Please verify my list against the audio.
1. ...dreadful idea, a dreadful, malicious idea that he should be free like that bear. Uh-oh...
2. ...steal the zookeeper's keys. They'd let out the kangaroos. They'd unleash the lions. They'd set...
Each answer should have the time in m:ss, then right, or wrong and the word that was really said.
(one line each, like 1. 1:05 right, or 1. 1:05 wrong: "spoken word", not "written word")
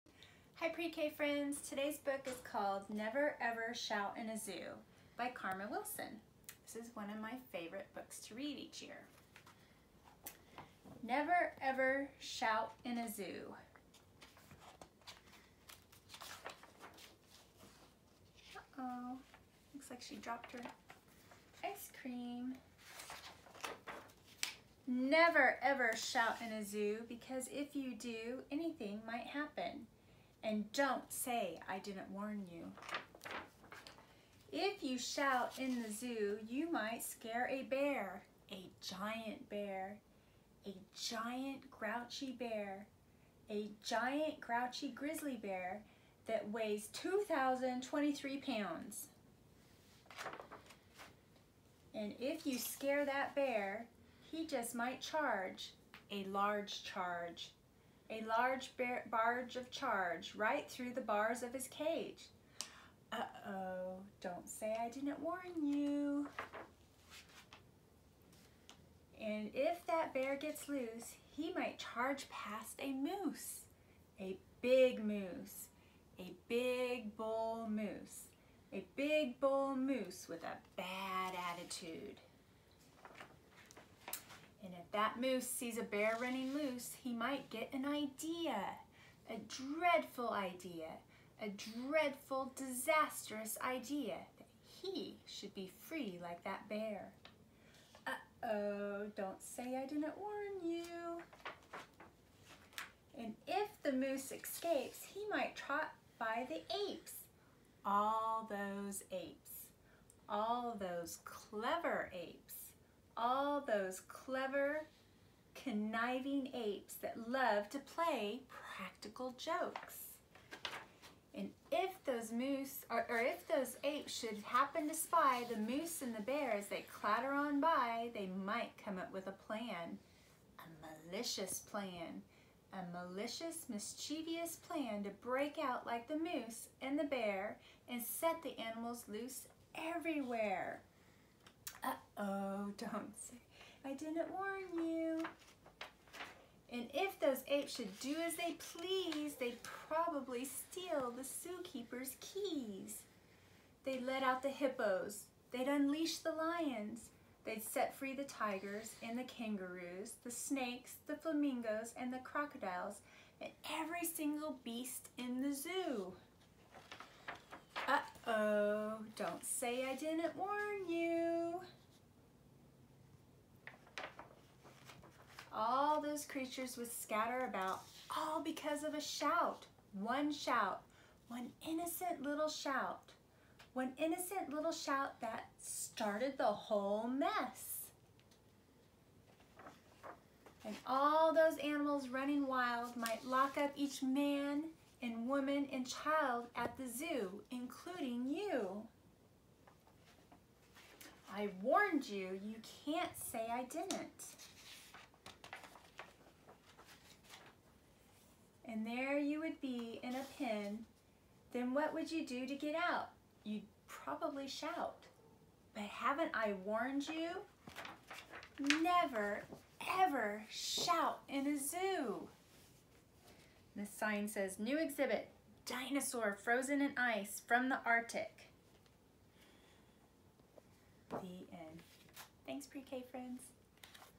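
1. 1:29 wrong: "disastrous", not "malicious"
2. 2:30 wrong: "hippos", not "kangaroos".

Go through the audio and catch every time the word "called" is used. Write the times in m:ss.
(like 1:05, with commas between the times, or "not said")
0:02.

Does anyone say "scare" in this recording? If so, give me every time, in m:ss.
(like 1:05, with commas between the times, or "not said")
0:37, 0:52.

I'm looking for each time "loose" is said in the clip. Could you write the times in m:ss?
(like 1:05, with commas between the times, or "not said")
1:10, 1:26, 2:19.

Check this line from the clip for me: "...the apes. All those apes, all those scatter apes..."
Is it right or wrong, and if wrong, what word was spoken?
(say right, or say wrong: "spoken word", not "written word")
wrong: "clever", not "scatter".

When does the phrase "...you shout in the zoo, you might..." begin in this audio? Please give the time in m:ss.
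0:34.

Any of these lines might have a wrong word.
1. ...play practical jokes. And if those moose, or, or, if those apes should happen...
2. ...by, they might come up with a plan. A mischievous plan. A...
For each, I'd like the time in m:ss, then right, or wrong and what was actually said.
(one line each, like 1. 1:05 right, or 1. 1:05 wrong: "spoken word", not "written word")
1. 1:57 right
2. 2:07 wrong: "malicious", not "mischievous".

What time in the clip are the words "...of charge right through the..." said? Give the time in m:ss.
0:59.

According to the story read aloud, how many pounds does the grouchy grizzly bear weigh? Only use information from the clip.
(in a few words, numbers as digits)
2,023.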